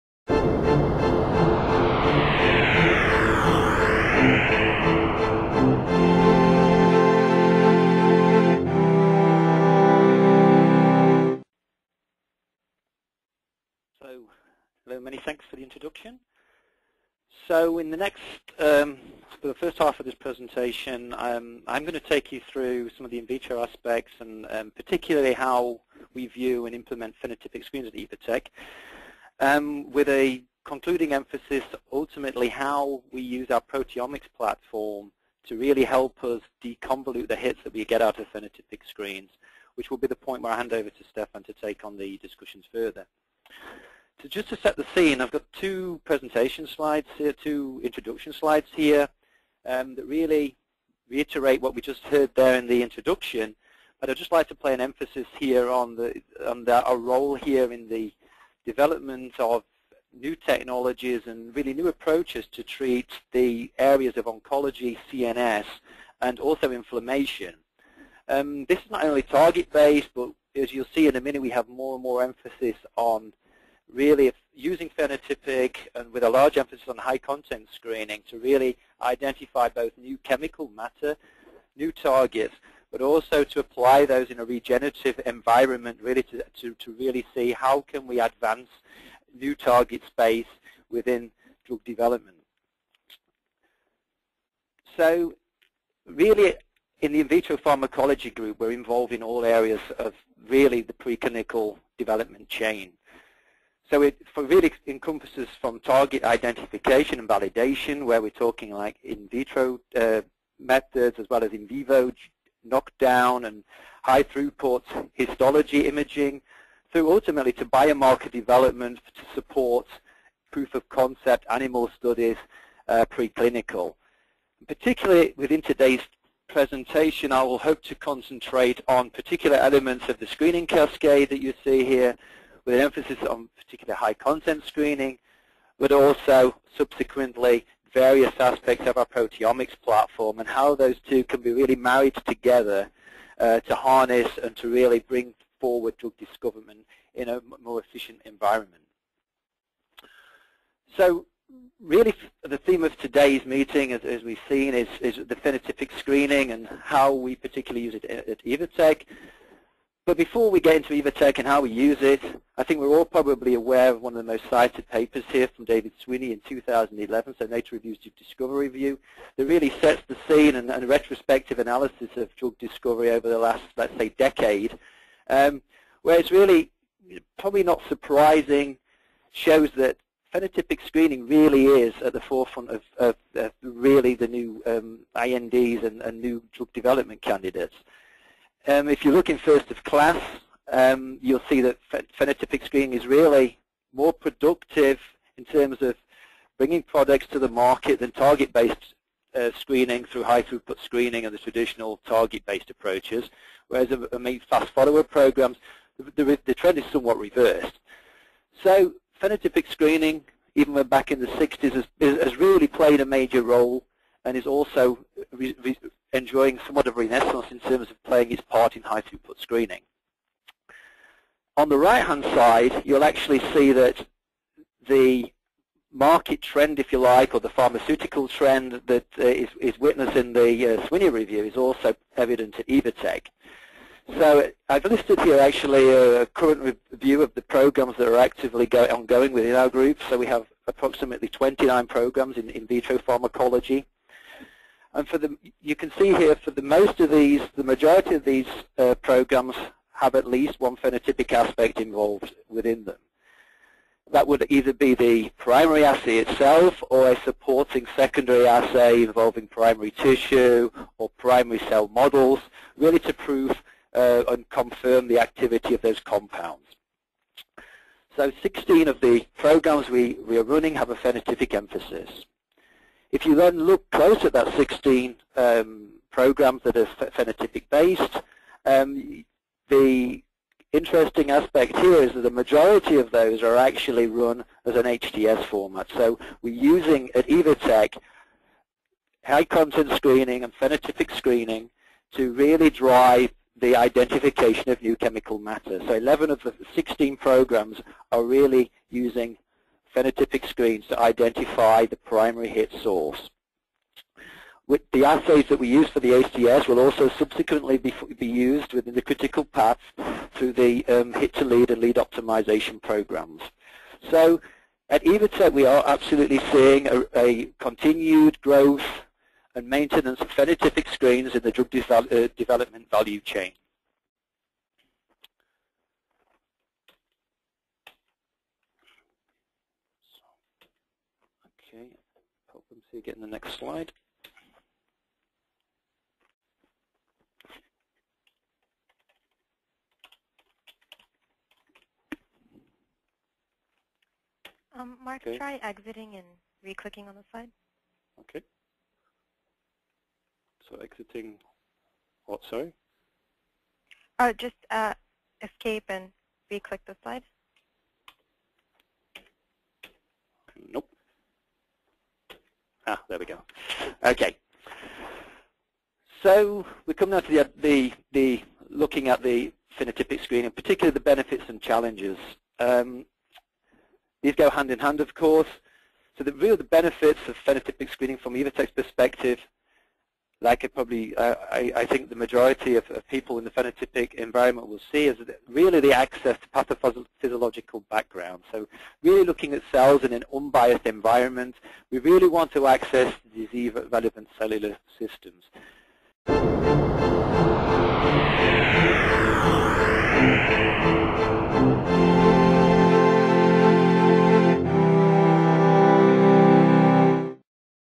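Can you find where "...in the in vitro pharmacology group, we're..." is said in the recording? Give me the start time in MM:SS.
01:36.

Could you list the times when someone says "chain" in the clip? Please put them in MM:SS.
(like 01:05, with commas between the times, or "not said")
01:42, 05:23.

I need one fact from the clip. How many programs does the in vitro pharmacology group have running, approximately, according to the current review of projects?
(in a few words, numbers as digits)
29.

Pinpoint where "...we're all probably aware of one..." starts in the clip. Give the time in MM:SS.
02:42.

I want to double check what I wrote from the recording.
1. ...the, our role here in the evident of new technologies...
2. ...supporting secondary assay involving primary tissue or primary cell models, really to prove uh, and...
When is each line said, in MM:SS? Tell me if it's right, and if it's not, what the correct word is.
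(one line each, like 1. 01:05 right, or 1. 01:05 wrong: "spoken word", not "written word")
1. 00:56 wrong: "development", not "evident"
2. 04:17 right.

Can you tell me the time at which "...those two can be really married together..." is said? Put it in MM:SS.
02:20.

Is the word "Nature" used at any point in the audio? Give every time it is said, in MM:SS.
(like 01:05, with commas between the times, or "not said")
02:47.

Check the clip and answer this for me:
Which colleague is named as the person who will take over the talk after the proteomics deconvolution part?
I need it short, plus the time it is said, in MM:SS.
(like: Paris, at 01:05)
Stefan, at 00:41.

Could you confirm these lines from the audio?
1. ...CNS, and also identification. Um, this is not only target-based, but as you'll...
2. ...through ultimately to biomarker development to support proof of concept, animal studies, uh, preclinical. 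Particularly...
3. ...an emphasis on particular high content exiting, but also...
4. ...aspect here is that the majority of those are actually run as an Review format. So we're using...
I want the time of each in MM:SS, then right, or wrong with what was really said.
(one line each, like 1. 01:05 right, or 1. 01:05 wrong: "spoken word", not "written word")
1. 01:05 wrong: "inflammation", not "identification"
2. 01:56 right
3. 02:12 wrong: "screening", not "exiting"
4. 04:41 wrong: "HTS", not "Review".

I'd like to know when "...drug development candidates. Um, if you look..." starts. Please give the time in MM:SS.
03:06.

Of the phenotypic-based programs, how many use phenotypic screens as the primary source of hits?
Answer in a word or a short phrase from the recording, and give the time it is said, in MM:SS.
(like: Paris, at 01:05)
11, at 04:55.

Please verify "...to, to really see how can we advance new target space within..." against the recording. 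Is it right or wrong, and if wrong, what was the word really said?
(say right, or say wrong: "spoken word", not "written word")
right.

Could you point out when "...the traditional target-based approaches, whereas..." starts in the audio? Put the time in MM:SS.
03:21.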